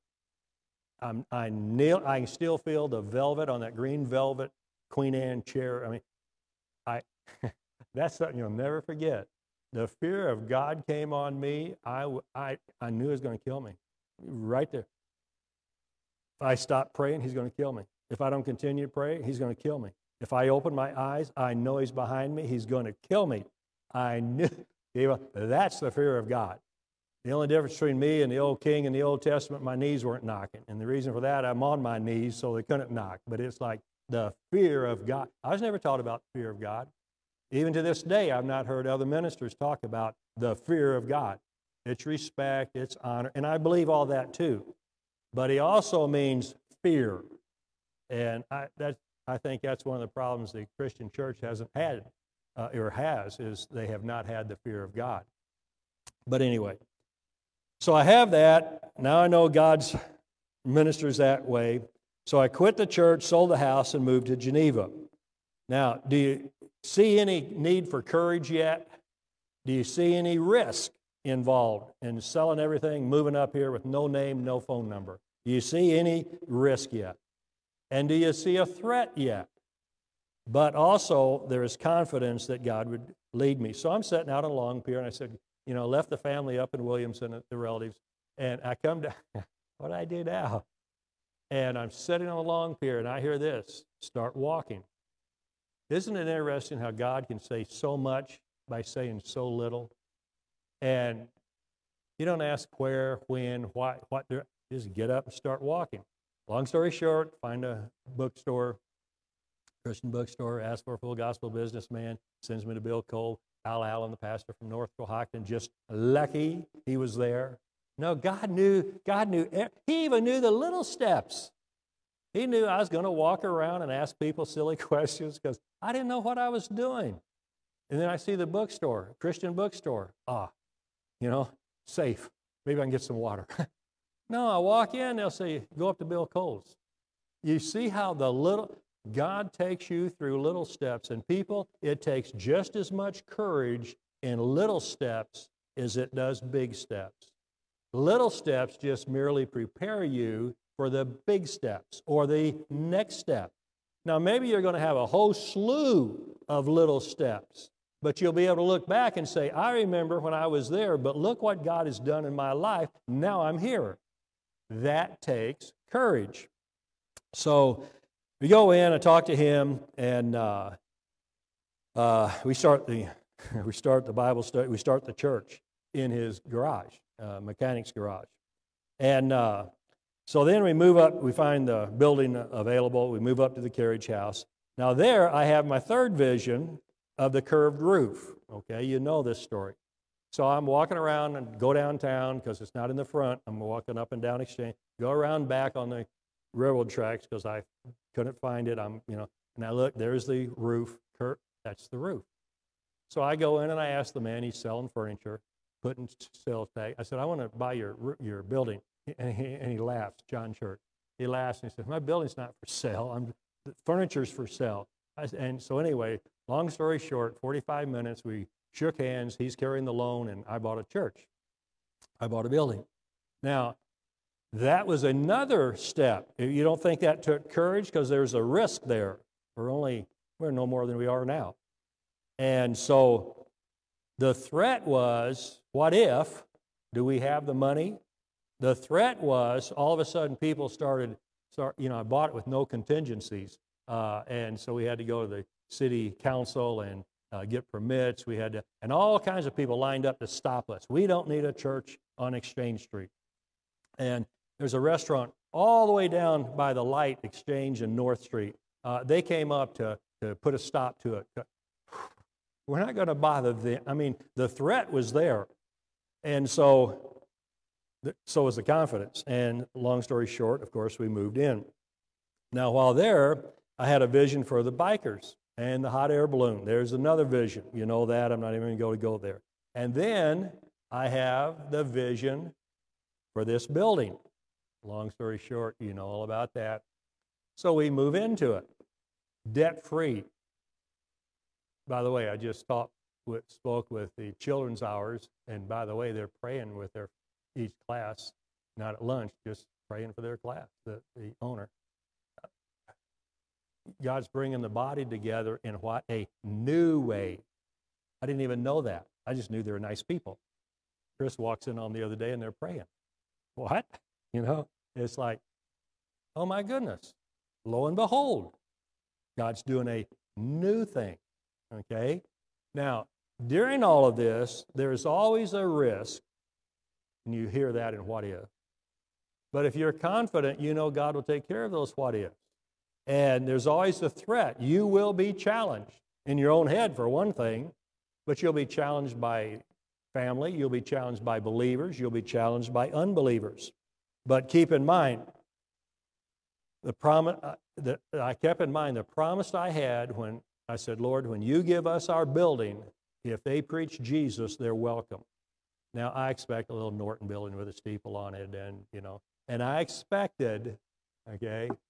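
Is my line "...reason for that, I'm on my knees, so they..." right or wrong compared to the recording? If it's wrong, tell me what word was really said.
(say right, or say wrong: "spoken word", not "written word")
right.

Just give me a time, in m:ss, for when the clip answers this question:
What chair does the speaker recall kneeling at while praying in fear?
0:03.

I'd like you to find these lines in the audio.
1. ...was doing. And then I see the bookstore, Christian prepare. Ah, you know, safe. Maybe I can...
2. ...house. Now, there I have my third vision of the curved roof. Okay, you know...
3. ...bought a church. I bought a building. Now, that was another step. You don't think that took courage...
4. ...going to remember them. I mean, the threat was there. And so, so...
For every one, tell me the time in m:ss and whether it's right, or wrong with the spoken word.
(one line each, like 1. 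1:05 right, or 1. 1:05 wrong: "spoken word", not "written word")
1. 2:06 wrong: "bookstore", not "prepare"
2. 3:04 right
3. 3:40 right
4. 4:22 wrong: "bother", not "remember".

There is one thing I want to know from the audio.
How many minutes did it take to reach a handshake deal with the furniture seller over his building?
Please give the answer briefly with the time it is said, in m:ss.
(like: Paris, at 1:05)
45, at 3:37.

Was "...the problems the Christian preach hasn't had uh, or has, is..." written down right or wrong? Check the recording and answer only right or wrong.
wrong.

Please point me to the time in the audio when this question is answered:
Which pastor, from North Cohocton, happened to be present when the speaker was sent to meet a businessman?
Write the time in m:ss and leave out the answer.
1:53.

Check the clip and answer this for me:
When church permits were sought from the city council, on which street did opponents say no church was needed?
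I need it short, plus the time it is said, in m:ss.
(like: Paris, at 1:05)
Exchange Street, at 4:12.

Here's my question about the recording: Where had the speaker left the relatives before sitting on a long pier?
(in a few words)
Williamson.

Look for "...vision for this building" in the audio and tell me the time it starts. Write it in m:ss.
4:41.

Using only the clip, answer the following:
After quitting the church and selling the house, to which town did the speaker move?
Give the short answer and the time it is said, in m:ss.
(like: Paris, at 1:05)
Geneva, at 1:04.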